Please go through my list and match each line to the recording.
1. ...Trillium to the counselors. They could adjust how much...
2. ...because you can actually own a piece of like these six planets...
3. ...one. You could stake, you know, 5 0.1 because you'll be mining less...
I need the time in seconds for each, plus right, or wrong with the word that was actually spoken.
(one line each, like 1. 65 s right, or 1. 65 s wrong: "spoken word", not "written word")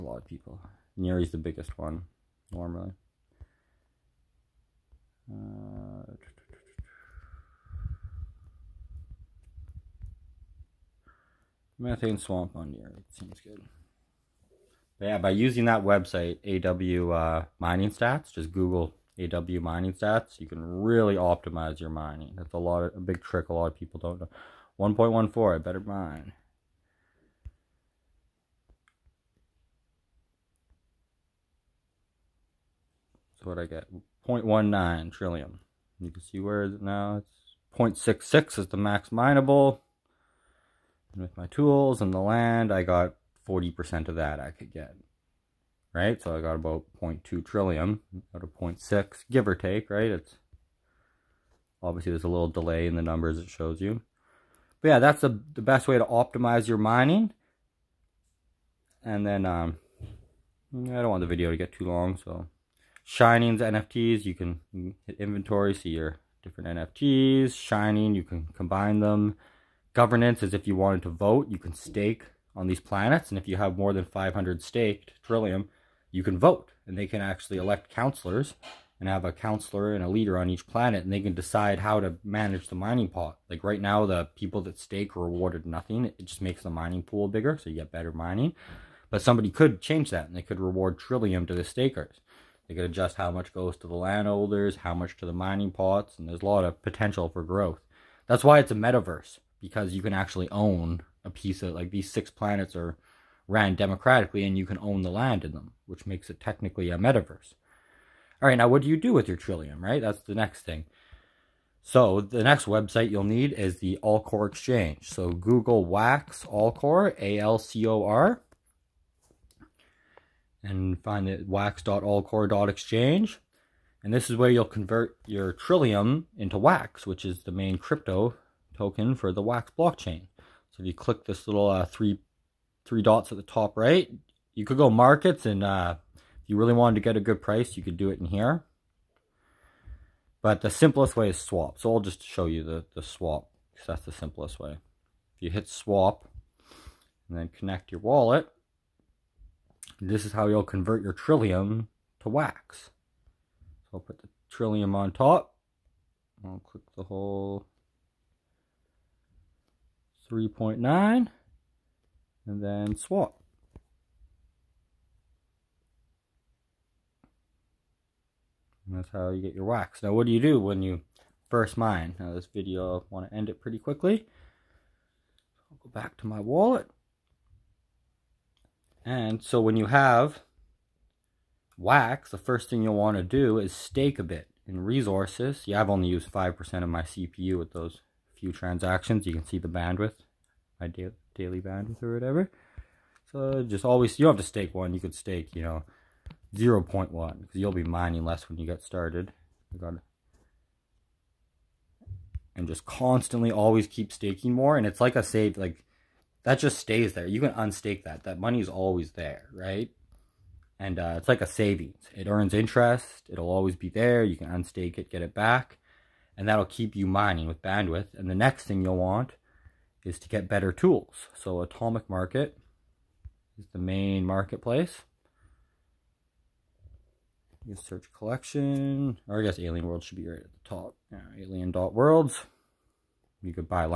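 1. 90 s wrong: "stakers", not "counselors"
2. 99 s right
3. 194 s wrong: "0", not "5".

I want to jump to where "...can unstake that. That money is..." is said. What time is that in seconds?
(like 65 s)
207 s.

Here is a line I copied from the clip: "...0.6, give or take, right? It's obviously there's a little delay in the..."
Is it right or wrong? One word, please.
right.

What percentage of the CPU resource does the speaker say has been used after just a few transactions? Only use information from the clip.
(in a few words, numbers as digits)
5%.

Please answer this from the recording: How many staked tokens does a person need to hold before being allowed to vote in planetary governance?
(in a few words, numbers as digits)
500.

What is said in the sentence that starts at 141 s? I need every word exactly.
So I'll just show you the, the swap because that's the simplest way.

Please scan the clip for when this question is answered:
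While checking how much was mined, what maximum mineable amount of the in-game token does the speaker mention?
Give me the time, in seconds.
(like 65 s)
38 s.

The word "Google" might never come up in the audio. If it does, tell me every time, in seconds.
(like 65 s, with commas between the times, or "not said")
18 s, 115 s.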